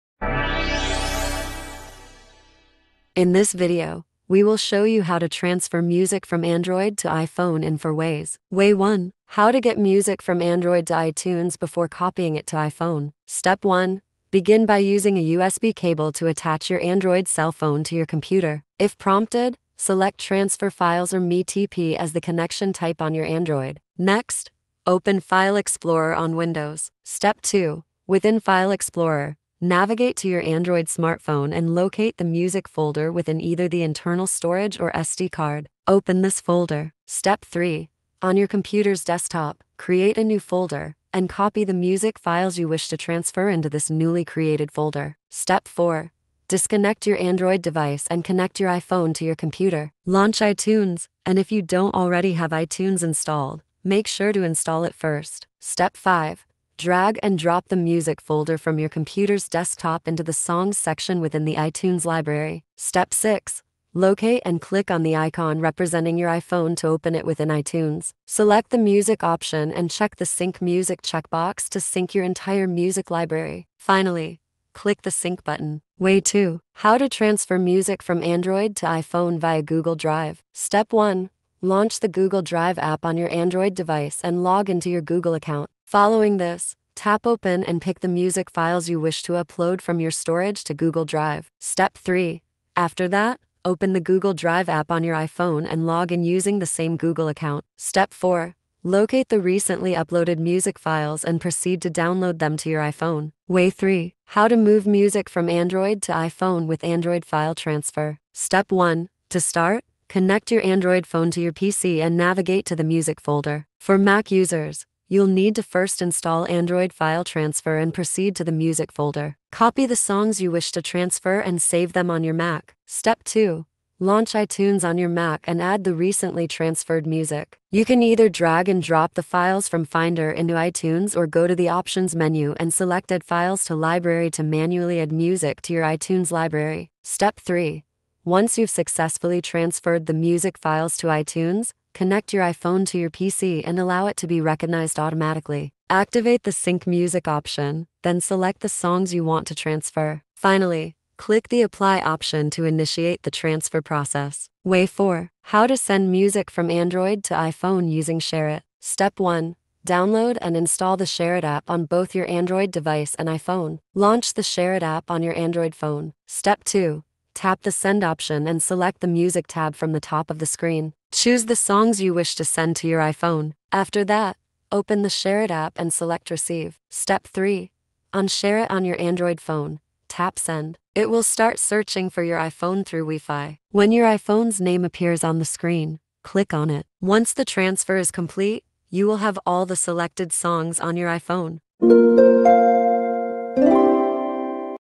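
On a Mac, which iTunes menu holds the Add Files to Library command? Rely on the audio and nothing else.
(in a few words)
Options.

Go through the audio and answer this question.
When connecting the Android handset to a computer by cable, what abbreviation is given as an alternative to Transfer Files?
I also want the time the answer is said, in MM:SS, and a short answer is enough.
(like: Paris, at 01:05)
MTP, at 00:21.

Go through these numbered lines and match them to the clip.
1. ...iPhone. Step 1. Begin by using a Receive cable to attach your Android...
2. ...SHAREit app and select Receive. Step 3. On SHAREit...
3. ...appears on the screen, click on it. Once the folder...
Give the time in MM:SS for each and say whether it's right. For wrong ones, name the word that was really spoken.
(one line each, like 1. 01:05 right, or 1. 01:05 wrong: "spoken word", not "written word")
1. 00:12 wrong: "USB", not "Receive"
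2. 02:55 right
3. 03:04 wrong: "transfer", not "folder".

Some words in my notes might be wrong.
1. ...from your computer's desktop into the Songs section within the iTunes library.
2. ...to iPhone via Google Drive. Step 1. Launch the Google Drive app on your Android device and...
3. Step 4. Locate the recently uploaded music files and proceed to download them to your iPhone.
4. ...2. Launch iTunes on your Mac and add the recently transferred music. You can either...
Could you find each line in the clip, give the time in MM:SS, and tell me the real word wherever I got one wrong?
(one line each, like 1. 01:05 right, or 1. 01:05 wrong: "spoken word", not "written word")
1. 00:58 right
2. 01:18 right
3. 01:37 right
4. 02:03 right.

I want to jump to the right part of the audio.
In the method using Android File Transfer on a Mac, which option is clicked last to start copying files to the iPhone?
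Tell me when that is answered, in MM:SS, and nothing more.
02:31.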